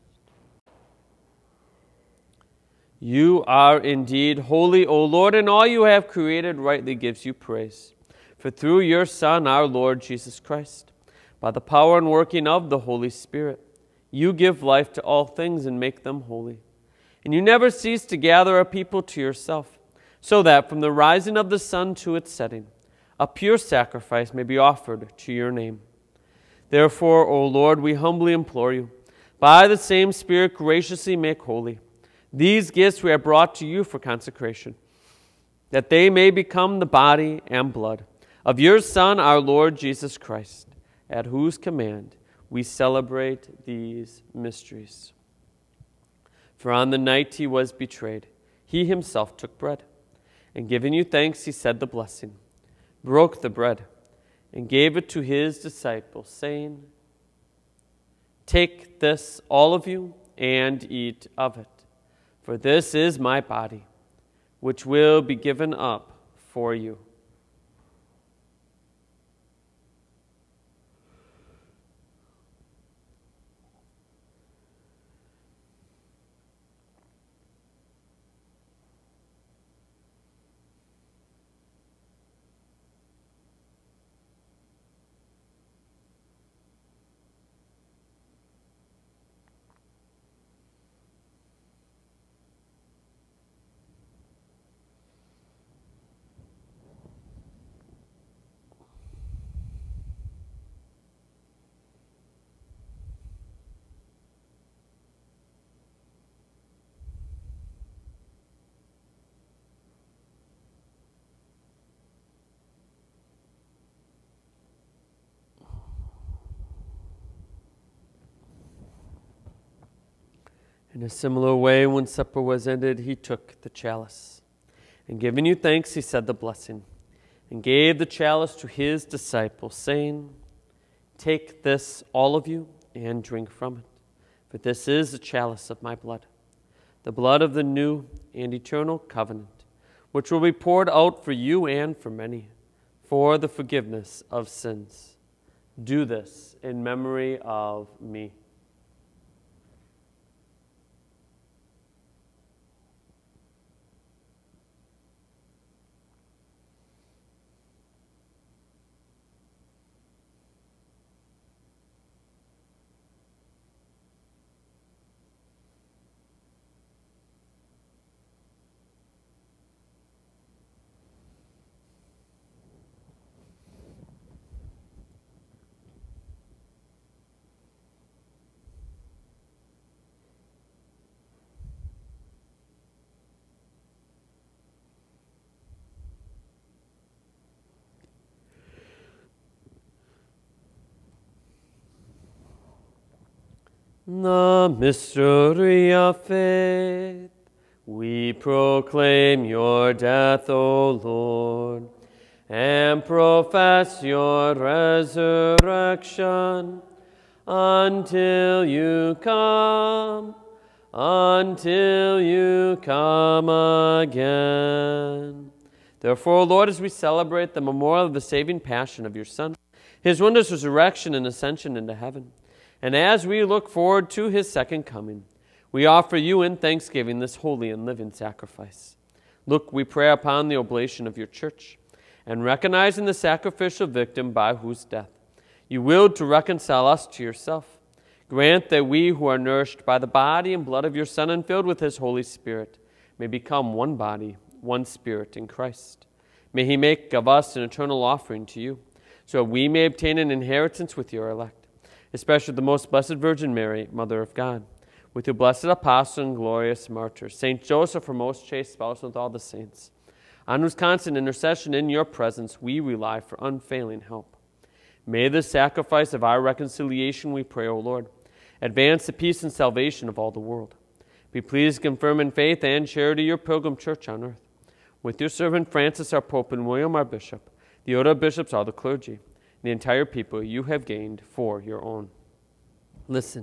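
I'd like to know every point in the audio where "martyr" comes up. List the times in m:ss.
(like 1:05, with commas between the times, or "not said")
4:16.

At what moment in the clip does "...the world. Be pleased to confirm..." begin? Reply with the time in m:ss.
4:30.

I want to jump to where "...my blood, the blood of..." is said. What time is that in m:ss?
2:15.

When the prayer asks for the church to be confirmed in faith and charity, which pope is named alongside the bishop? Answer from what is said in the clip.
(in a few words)
Francis.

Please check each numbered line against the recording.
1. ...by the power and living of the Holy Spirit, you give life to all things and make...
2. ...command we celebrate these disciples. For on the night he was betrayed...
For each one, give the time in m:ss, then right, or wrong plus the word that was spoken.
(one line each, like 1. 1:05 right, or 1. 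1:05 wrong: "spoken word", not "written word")
1. 0:11 wrong: "working", not "living"
2. 0:41 wrong: "mysteries", not "disciples".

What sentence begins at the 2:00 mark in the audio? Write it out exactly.
In a similar way, when supper was ended, he took the chalice.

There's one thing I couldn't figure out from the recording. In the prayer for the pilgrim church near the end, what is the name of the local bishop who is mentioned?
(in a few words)
William.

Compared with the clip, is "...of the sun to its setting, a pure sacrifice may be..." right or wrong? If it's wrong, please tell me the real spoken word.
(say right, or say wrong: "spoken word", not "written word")
right.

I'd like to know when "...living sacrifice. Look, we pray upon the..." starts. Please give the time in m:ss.
3:47.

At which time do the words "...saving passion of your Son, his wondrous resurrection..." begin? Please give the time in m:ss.
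3:38.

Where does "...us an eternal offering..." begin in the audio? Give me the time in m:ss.
4:07.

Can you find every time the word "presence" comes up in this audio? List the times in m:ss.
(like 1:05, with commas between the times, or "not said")
4:22.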